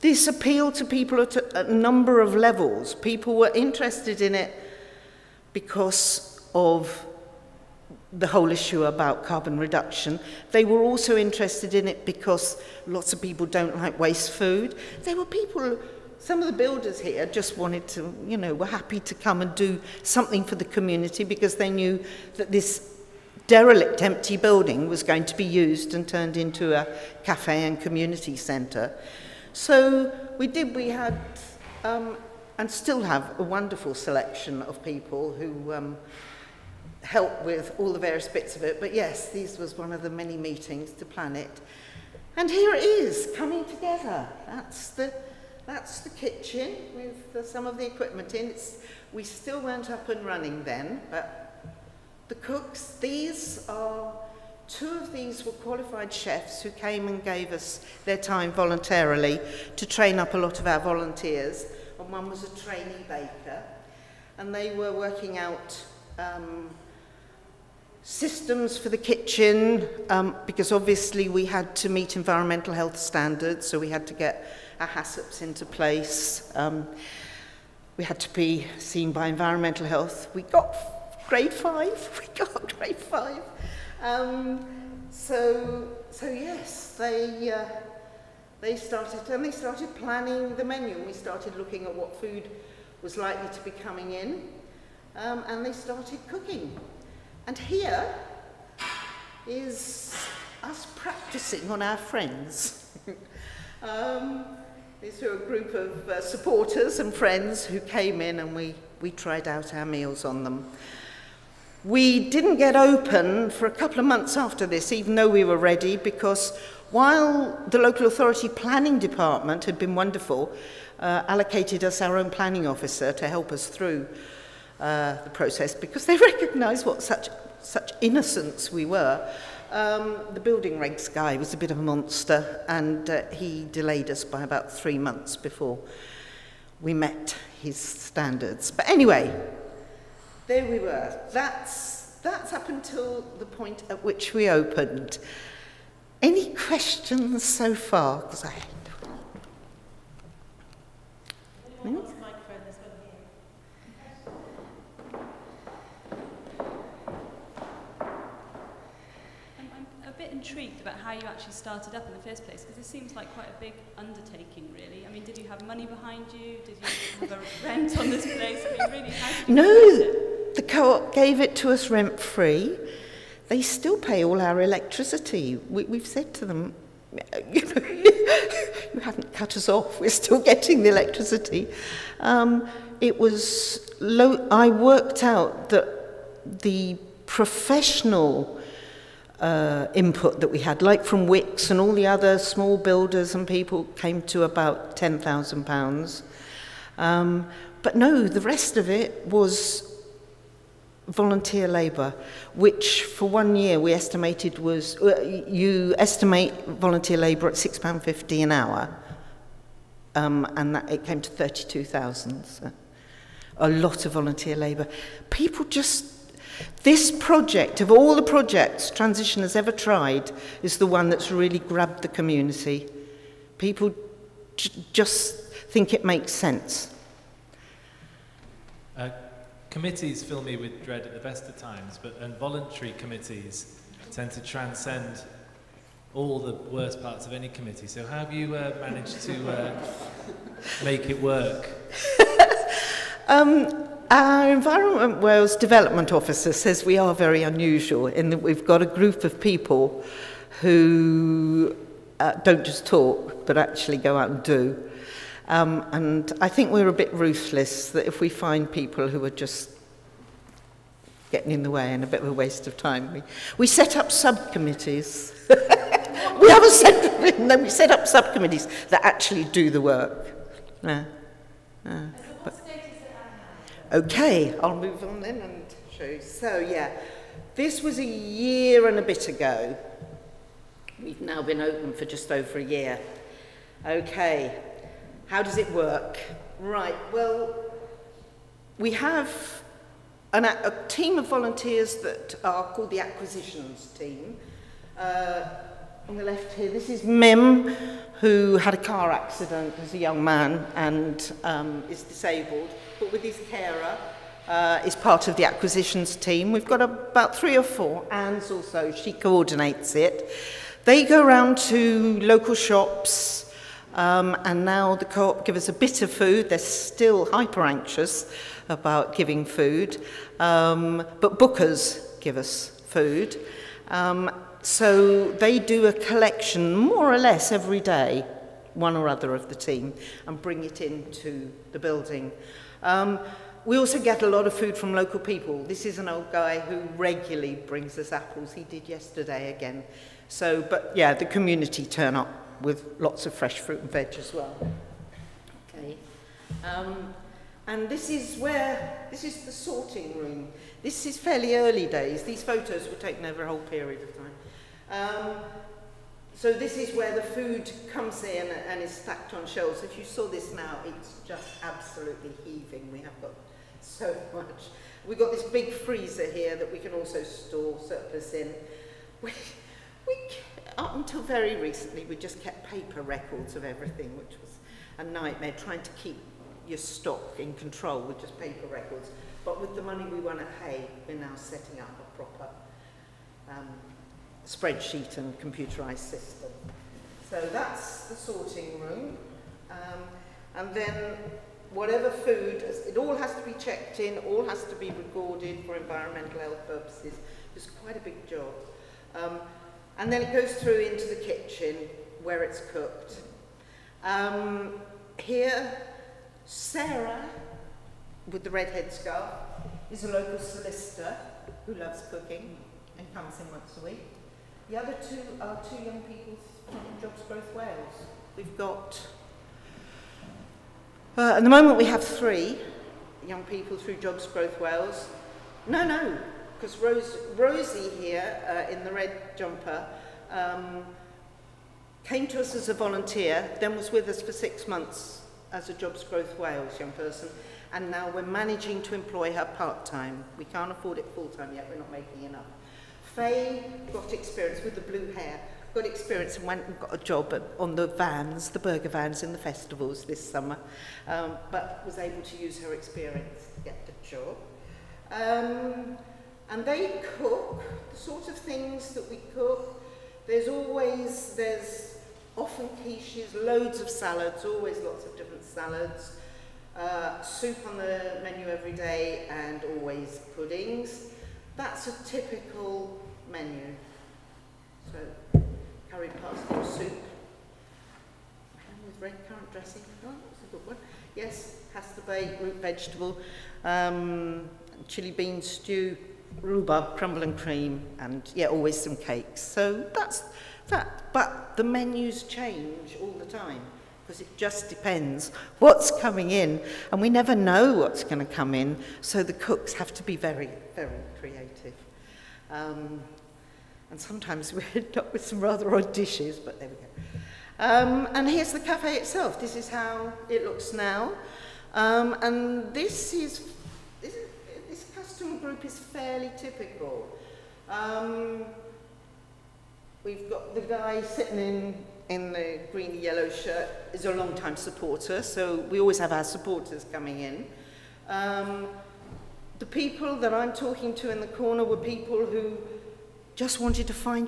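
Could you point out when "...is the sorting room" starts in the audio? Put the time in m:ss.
5:49.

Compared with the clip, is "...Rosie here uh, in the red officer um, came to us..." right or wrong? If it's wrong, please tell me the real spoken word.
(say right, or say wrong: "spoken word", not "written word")
wrong: "jumper", not "officer".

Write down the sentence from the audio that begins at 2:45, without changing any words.
I mean, did you have money behind you?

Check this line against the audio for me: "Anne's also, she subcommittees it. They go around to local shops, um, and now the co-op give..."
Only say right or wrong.
wrong.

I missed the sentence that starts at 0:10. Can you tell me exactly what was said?
They were also interested in it because lots of people don't like waste food.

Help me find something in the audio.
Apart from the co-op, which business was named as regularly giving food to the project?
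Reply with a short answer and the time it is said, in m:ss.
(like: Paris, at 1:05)
Bookers, at 5:21.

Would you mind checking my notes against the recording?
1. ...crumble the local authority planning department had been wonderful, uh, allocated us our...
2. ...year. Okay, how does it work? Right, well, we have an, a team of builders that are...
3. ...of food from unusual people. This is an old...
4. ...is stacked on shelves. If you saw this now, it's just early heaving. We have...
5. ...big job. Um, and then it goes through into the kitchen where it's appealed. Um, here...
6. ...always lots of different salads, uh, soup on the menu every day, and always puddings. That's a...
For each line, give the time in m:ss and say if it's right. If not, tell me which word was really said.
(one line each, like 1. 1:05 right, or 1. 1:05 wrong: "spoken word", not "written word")
1. 1:56 wrong: "while", not "crumble"
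2. 4:42 wrong: "volunteers", not "builders"
3. 5:34 wrong: "local", not "unusual"
4. 5:58 wrong: "absolutely", not "early"
5. 6:37 wrong: "cooked", not "appealed"
6. 7:44 right.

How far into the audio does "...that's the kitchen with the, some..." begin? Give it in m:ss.
0:45.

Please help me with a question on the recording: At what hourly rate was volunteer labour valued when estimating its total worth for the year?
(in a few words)
£6.50.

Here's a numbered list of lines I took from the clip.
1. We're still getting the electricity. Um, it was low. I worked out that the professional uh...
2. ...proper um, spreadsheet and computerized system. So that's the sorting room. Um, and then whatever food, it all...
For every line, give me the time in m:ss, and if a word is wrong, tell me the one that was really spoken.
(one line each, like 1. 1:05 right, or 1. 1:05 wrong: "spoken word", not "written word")
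1. 3:00 right
2. 6:22 right.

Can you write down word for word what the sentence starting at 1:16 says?
Um, we had to be seen by environmental health.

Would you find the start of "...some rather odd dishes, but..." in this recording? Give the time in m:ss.
8:25.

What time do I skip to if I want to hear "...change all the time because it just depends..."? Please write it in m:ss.
8:12.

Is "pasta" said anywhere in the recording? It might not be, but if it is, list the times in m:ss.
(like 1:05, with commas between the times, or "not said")
7:56, 8:01.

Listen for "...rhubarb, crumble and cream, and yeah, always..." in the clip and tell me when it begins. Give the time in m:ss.
8:06.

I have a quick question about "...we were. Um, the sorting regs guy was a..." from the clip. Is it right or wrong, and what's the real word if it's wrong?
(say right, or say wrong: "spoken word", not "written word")
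wrong: "building", not "sorting".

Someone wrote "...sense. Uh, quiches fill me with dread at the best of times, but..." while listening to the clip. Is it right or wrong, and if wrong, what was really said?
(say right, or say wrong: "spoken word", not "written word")
wrong: "committees", not "quiches".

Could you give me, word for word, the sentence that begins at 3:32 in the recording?
So a lot of volunteer labour.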